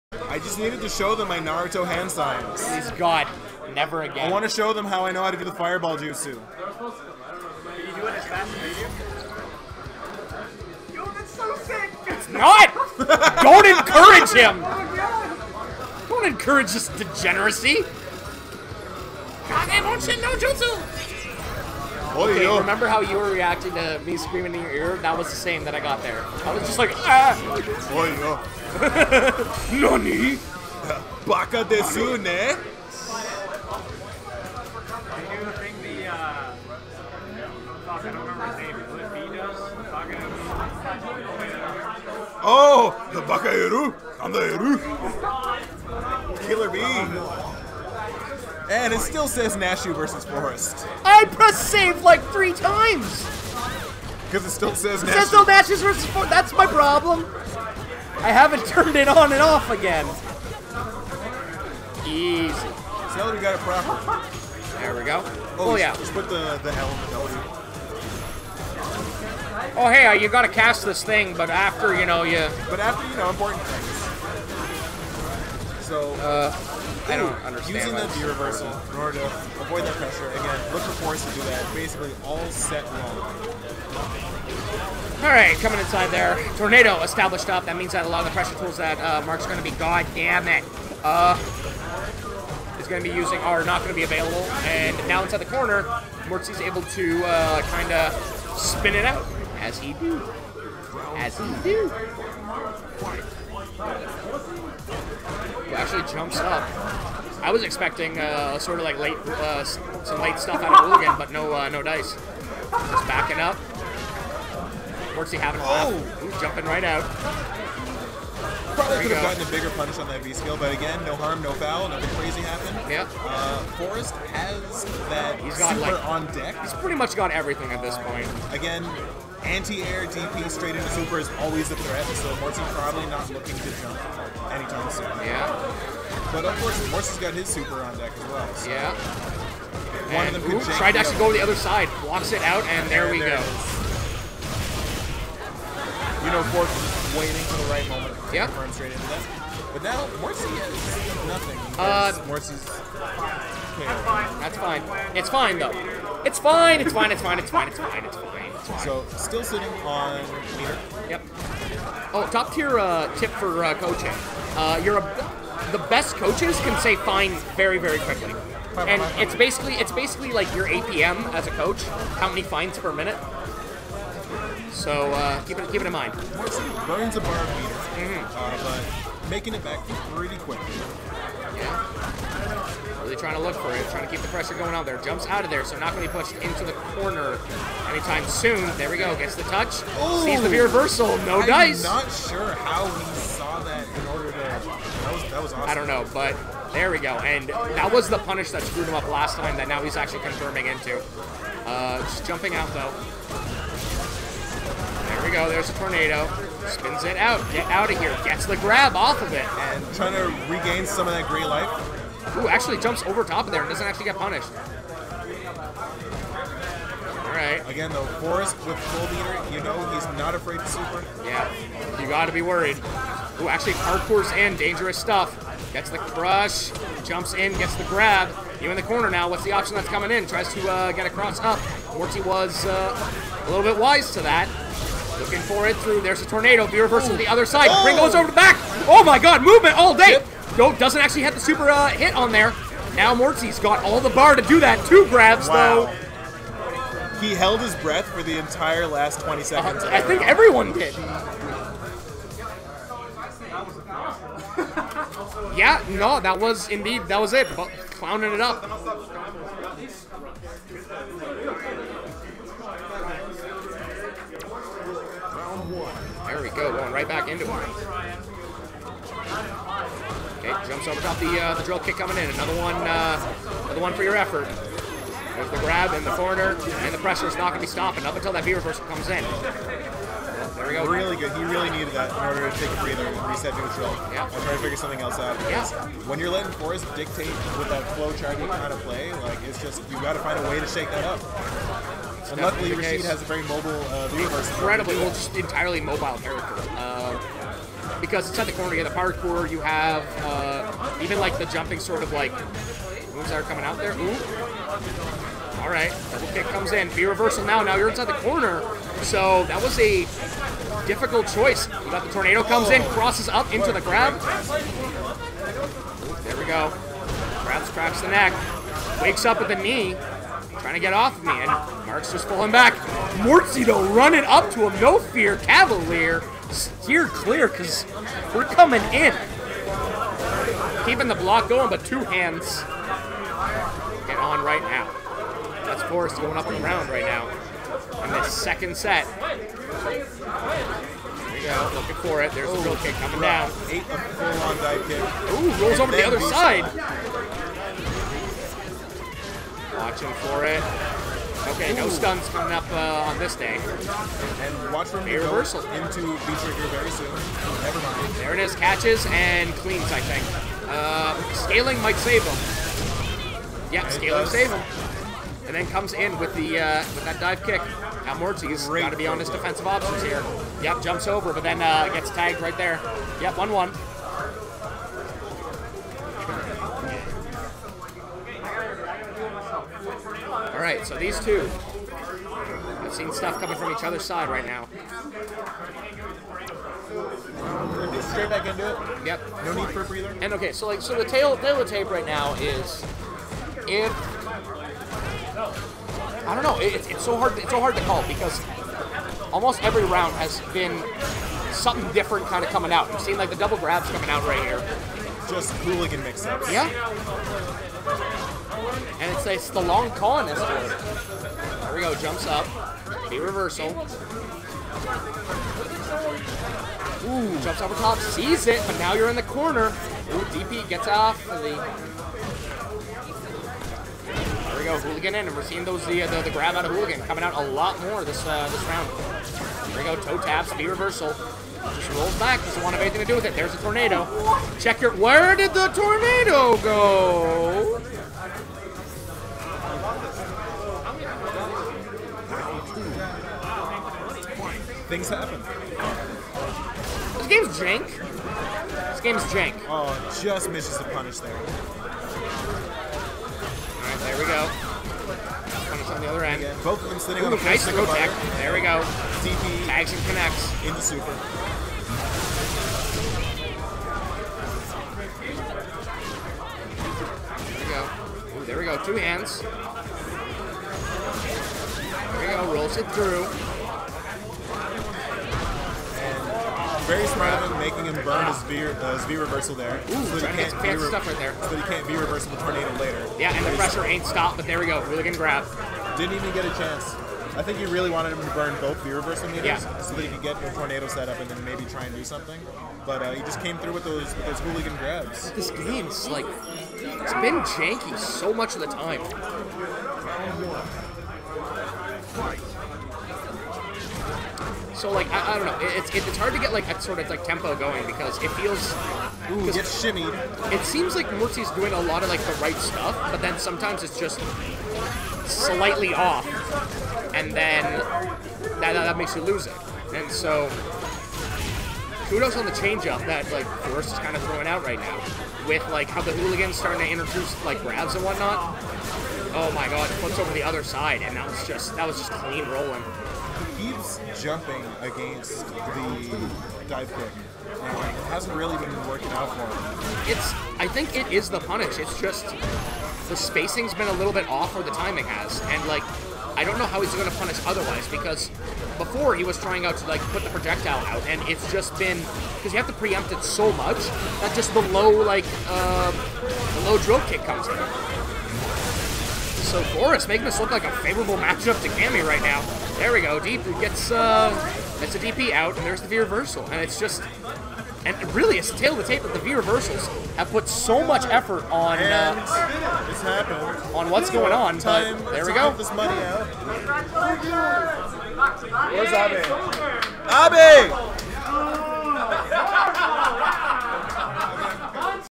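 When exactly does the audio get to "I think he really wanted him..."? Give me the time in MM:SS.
08:07.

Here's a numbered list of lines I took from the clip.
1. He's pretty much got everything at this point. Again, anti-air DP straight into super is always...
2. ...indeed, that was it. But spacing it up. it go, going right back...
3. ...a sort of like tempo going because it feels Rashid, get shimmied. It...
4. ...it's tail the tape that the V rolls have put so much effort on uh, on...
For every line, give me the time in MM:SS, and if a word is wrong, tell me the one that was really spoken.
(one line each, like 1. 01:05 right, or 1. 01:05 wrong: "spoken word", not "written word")
1. 02:06 right
2. 04:16 wrong: "clowning", not "spacing"
3. 08:26 wrong: "Ooh", not "Rashid"
4. 09:28 wrong: "reversals", not "rolls".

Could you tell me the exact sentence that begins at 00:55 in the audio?
It says no Nashu versus Forest.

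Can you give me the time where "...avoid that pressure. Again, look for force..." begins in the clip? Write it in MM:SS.
01:19.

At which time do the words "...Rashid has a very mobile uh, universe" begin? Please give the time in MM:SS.
04:52.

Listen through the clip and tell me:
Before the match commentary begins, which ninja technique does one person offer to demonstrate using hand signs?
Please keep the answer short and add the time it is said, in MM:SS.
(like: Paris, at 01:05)
fireball jutsu, at 00:05.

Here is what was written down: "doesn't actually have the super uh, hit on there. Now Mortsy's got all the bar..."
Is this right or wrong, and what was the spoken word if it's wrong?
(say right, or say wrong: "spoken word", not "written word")
right.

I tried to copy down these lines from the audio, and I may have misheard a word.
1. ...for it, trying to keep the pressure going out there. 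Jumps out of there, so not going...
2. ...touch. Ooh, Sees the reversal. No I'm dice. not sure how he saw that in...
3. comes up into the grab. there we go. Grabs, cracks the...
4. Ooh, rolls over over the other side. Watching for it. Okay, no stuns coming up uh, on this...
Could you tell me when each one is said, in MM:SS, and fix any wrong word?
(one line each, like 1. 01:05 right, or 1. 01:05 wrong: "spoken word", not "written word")
1. 03:03 right
2. 03:09 right
3. 05:12 wrong: "crosses", not "comes"
4. 05:45 right.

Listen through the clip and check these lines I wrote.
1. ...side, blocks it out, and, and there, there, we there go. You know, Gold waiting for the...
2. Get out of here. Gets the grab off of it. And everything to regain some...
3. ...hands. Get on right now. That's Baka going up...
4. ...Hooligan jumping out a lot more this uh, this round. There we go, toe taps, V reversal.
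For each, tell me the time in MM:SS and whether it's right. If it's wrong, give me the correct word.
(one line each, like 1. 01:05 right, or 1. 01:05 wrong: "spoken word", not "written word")
1. 02:21 wrong: "Forest", not "Gold"
2. 03:27 wrong: "trying", not "everything"
3. 05:32 wrong: "Forest", not "Baka"
4. 07:06 wrong: "coming", not "jumping".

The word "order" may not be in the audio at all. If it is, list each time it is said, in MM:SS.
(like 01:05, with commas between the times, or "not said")
01:18, 03:14, 04:42.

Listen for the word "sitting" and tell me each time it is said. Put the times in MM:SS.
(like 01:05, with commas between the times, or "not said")
02:39, 07:36.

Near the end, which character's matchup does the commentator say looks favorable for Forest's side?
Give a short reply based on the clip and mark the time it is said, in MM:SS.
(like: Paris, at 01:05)
Cammy, at 09:21.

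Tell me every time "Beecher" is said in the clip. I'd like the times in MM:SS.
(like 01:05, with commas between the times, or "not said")
05:56.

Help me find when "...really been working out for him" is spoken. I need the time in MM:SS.
08:58.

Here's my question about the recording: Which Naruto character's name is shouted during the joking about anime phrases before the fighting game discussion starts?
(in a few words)
Killer Bee.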